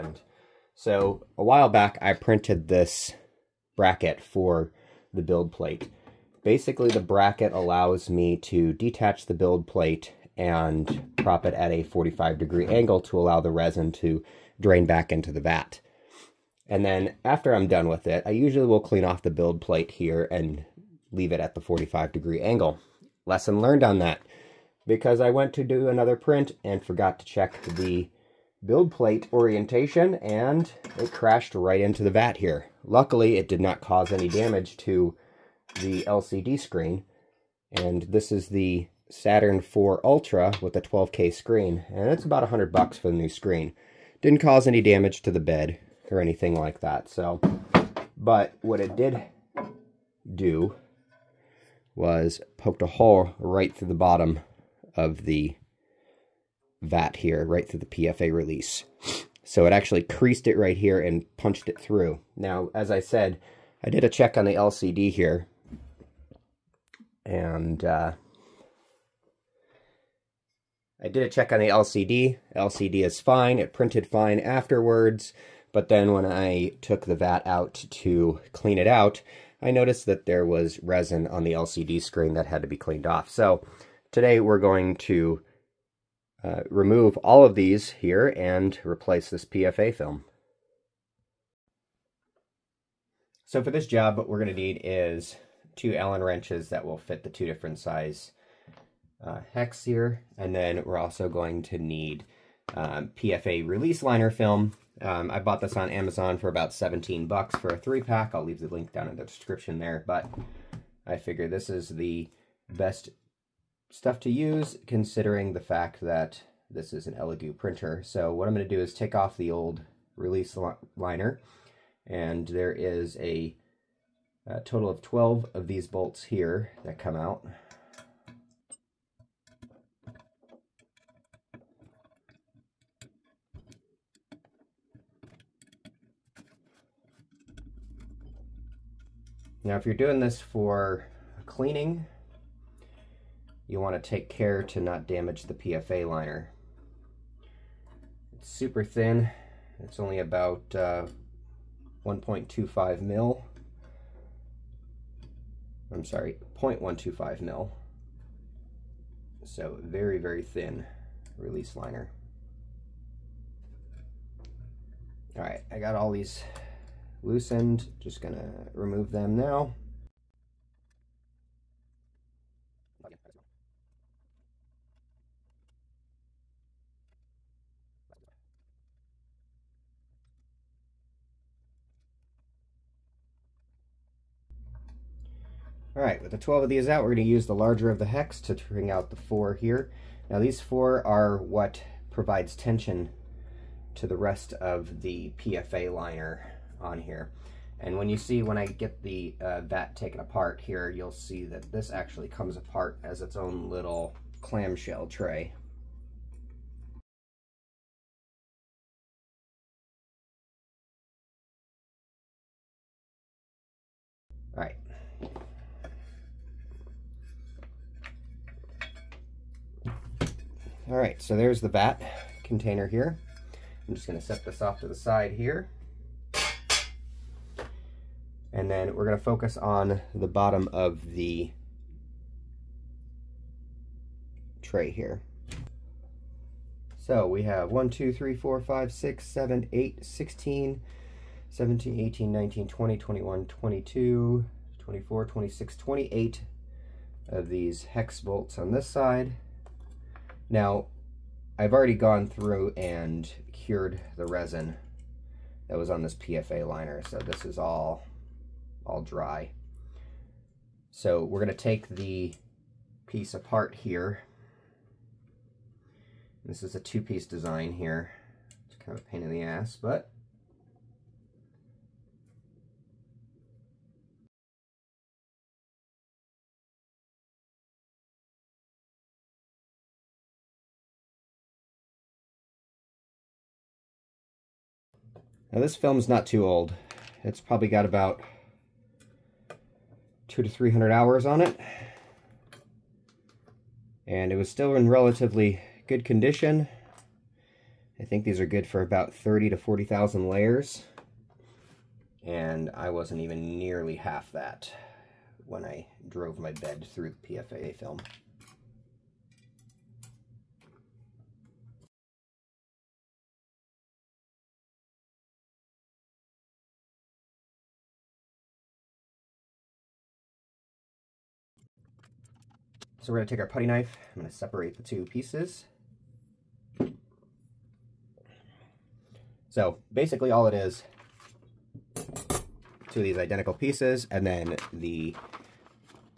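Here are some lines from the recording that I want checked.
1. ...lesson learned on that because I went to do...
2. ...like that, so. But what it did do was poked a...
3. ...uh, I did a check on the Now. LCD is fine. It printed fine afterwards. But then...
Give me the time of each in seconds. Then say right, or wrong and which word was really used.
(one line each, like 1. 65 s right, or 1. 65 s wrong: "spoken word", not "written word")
1. 23 s right
2. 46 s right
3. 67 s wrong: "LCD", not "Now".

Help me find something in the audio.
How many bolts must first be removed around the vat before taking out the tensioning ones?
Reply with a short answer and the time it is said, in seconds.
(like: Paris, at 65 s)
12, at 124 s.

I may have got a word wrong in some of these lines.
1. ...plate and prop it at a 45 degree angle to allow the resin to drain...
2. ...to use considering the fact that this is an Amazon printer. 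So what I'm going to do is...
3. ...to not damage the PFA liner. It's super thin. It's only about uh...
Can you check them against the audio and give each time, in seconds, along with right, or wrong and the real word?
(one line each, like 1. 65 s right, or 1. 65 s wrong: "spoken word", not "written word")
1. 9 s right
2. 114 s wrong: "Elegoo", not "Amazon"
3. 144 s right.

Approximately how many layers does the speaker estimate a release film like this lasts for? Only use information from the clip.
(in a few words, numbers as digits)
30,000 to 40,000.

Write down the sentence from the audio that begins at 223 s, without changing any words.
I'm just gonna set this off to the side here.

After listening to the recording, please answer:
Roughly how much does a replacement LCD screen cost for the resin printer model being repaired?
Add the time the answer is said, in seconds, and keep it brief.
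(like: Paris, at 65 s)
$100, at 42 s.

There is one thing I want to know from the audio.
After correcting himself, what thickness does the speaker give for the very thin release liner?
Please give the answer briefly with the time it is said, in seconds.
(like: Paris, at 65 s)
0.125 mil, at 156 s.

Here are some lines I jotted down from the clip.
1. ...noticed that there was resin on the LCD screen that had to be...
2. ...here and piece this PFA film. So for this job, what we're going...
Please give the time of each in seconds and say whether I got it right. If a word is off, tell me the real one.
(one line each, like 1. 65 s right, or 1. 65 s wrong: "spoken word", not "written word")
1. 79 s right
2. 87 s wrong: "replace", not "piece".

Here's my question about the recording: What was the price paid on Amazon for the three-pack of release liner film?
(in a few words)
$17.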